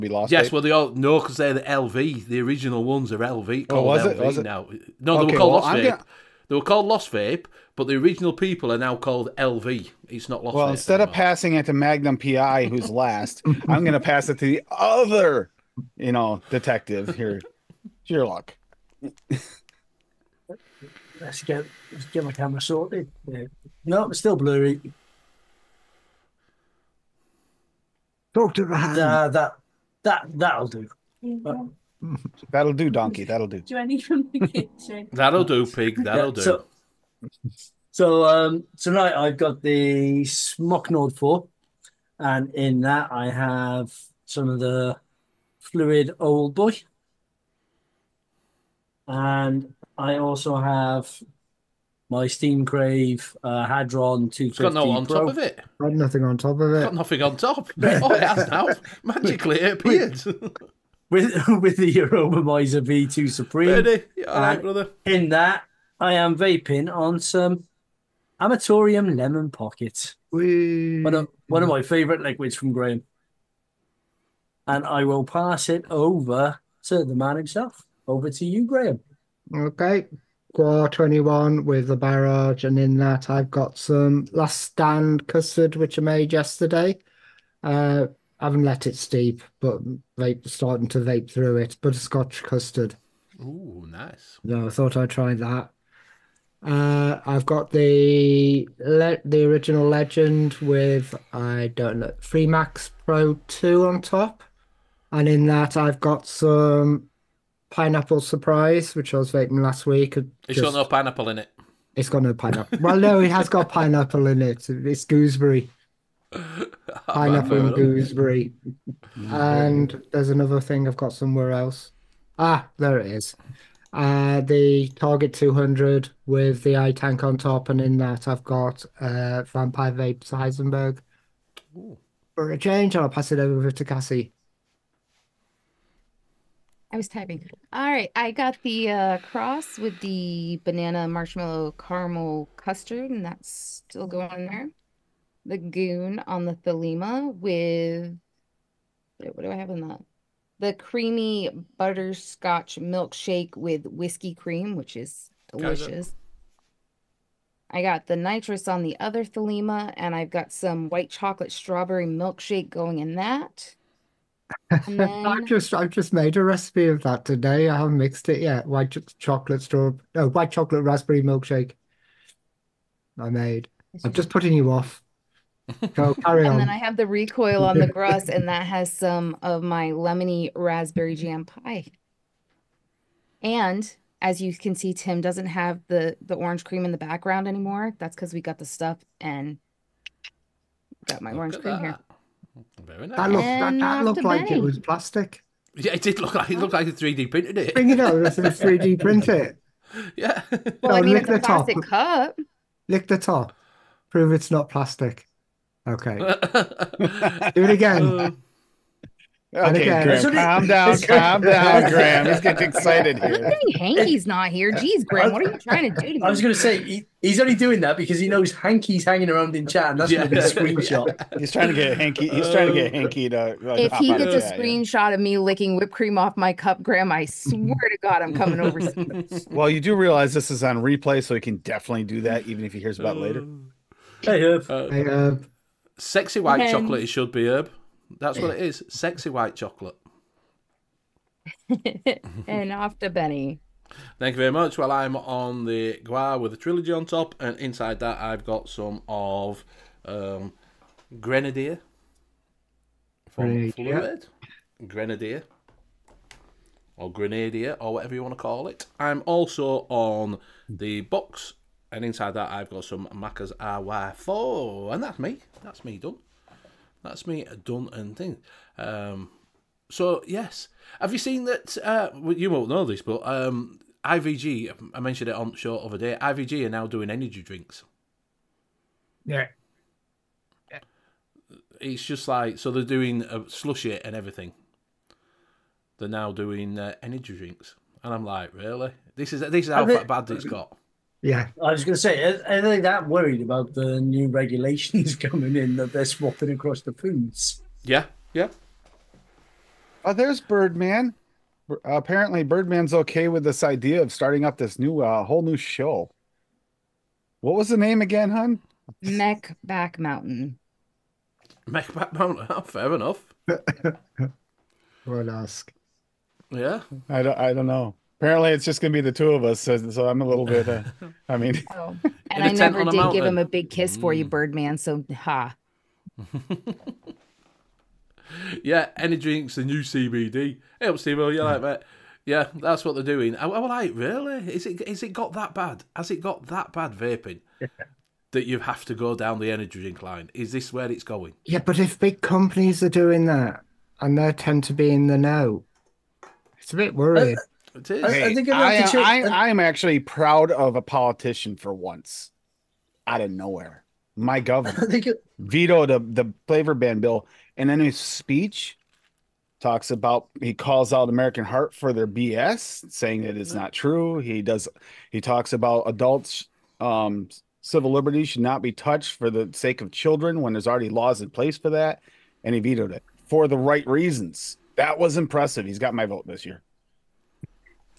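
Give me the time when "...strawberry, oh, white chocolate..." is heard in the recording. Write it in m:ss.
2:49.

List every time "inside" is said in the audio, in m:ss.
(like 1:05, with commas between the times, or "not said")
4:07, 4:22.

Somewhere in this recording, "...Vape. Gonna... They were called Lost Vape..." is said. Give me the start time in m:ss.
0:05.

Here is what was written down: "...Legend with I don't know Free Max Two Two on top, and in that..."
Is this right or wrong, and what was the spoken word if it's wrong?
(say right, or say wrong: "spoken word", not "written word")
wrong: "Pro", not "Two".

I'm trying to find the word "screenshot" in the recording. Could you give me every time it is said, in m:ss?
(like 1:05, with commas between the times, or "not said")
3:40, 3:44.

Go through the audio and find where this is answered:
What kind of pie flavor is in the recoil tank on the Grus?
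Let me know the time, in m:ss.
2:59.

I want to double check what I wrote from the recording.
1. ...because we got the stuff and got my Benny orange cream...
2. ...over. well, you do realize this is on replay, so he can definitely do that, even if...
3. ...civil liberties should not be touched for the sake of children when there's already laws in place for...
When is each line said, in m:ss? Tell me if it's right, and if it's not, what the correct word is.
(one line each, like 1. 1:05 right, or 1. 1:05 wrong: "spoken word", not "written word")
1. 3:08 wrong: "Look", not "Benny"
2. 3:48 right
3. 6:07 right.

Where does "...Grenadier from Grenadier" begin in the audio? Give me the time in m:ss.
4:11.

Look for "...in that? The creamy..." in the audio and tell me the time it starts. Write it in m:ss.
2:29.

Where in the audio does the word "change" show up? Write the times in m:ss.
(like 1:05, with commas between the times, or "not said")
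2:12.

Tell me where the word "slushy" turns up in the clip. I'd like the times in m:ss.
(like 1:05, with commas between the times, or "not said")
4:43.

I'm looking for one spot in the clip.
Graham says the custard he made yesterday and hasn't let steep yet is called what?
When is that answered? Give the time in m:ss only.
1:24.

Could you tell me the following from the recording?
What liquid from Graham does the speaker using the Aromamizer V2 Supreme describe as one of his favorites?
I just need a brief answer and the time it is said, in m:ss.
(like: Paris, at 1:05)
Amatorium Lemon Pocket, at 1:08.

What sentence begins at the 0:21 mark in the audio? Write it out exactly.
Let's get let's get my camera sorted.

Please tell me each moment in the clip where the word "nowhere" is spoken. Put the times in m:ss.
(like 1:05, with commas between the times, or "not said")
5:53.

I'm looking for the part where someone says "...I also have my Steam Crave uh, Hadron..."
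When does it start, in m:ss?
0:49.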